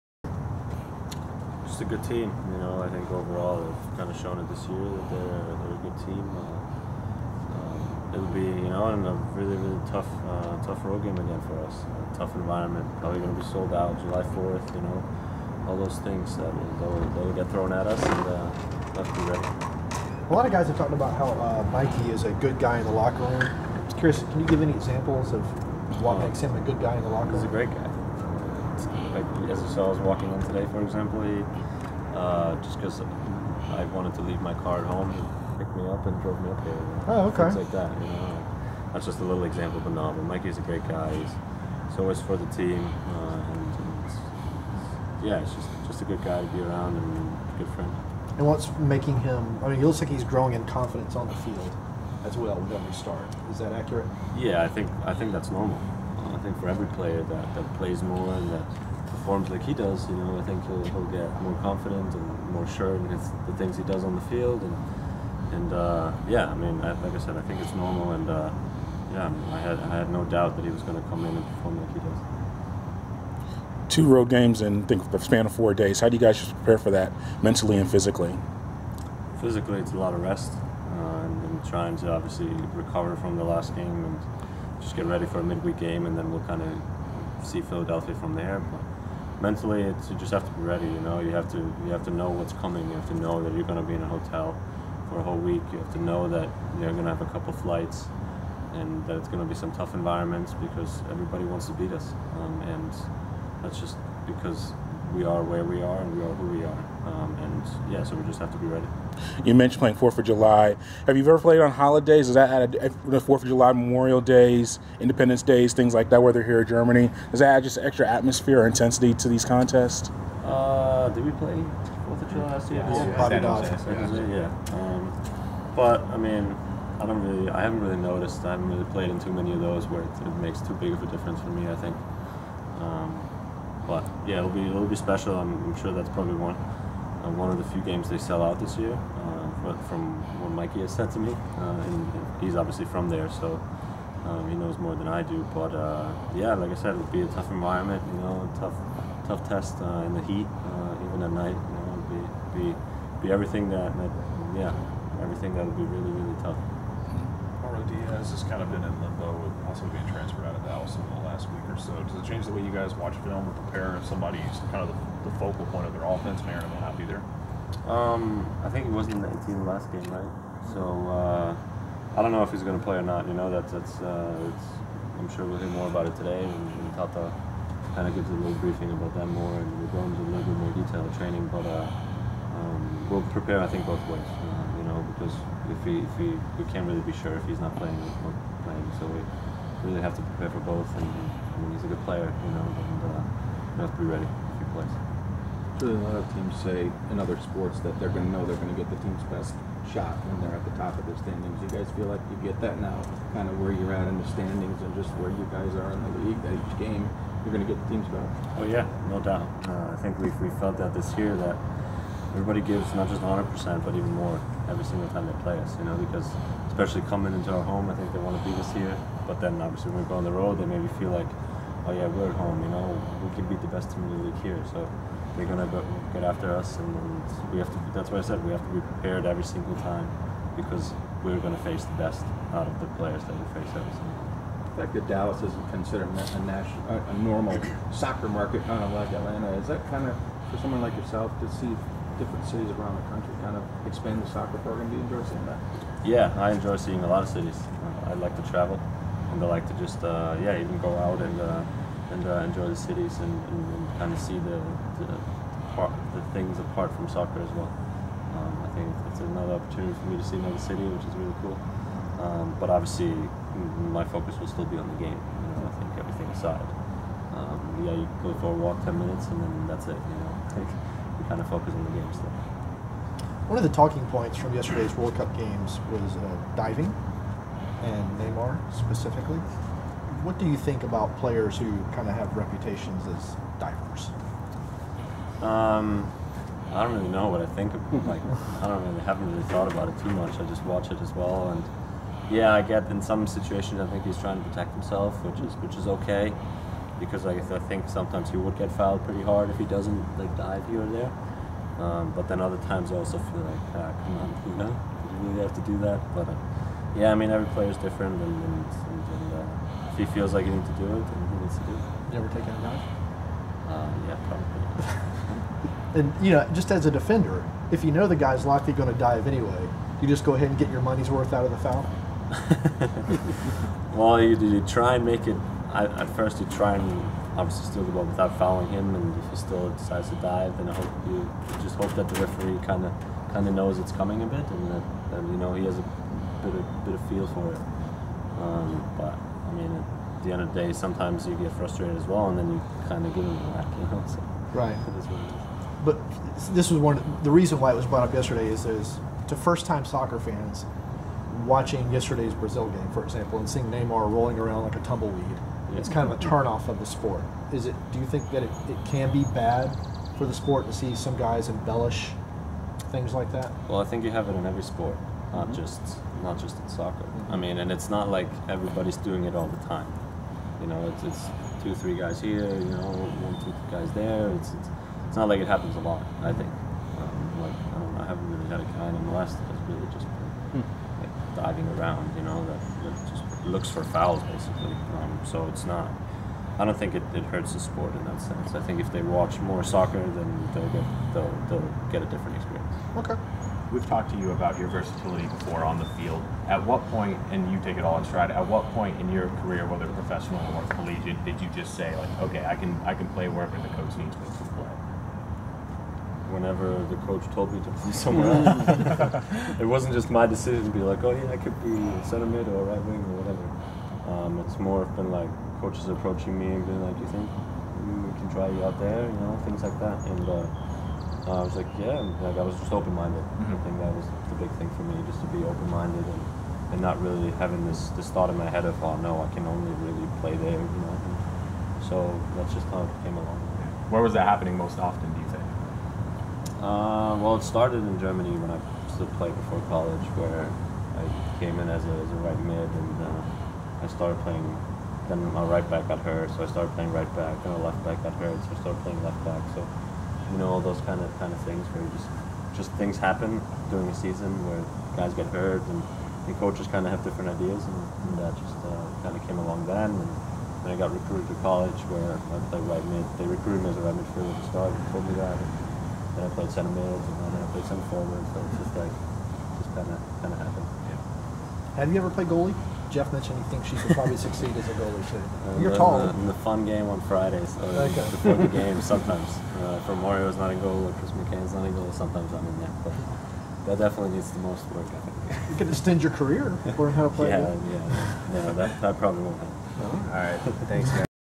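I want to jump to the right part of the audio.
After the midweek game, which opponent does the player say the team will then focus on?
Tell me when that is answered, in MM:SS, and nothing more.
01:27.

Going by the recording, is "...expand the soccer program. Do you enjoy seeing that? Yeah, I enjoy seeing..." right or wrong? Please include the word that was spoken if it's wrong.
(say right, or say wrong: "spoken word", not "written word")
right.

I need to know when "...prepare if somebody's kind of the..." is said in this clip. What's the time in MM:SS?
02:43.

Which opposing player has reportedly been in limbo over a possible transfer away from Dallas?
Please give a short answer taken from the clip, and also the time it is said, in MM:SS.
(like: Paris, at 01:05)
Carlos Diaz, at 02:37.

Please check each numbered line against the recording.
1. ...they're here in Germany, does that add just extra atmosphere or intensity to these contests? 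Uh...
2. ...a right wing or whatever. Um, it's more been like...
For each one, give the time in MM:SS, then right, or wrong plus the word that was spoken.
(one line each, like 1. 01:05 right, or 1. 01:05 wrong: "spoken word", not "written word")
1. 01:56 right
2. 06:52 right.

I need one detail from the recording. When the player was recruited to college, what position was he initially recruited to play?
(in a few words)
right midfielder.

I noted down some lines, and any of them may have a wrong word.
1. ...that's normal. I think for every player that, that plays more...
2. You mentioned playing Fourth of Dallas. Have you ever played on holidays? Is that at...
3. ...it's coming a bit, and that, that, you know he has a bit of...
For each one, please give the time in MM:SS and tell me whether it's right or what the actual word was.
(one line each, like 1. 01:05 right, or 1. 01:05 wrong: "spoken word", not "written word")
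1. 00:55 right
2. 01:49 wrong: "July", not "Dallas"
3. 05:33 right.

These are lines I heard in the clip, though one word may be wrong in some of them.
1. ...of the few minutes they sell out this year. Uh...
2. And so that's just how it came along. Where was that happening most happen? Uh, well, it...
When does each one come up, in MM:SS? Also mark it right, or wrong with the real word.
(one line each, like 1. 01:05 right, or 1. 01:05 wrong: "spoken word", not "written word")
1. 02:17 wrong: "games", not "minutes"
2. 07:10 wrong: "often", not "happen".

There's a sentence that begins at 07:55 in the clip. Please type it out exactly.
The, the, fun game on Fridays so okay.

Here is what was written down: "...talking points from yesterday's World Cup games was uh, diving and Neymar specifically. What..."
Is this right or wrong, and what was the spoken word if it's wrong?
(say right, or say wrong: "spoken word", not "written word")
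right.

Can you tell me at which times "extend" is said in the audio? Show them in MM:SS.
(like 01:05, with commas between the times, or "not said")
08:05.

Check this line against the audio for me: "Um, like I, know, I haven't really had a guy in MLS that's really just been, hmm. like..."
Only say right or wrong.
right.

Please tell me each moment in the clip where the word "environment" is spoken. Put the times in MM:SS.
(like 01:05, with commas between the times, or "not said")
00:12, 01:39, 02:27.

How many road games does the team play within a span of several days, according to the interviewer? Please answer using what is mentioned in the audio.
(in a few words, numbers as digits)
2.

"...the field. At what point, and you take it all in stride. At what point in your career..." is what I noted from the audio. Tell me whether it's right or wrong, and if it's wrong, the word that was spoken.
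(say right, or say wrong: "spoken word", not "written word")
right.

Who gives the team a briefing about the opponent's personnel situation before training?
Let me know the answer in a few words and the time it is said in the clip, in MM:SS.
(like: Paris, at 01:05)
Tata, at 02:56.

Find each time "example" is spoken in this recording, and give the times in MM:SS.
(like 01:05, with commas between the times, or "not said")
00:24, 00:30, 00:39, 05:53.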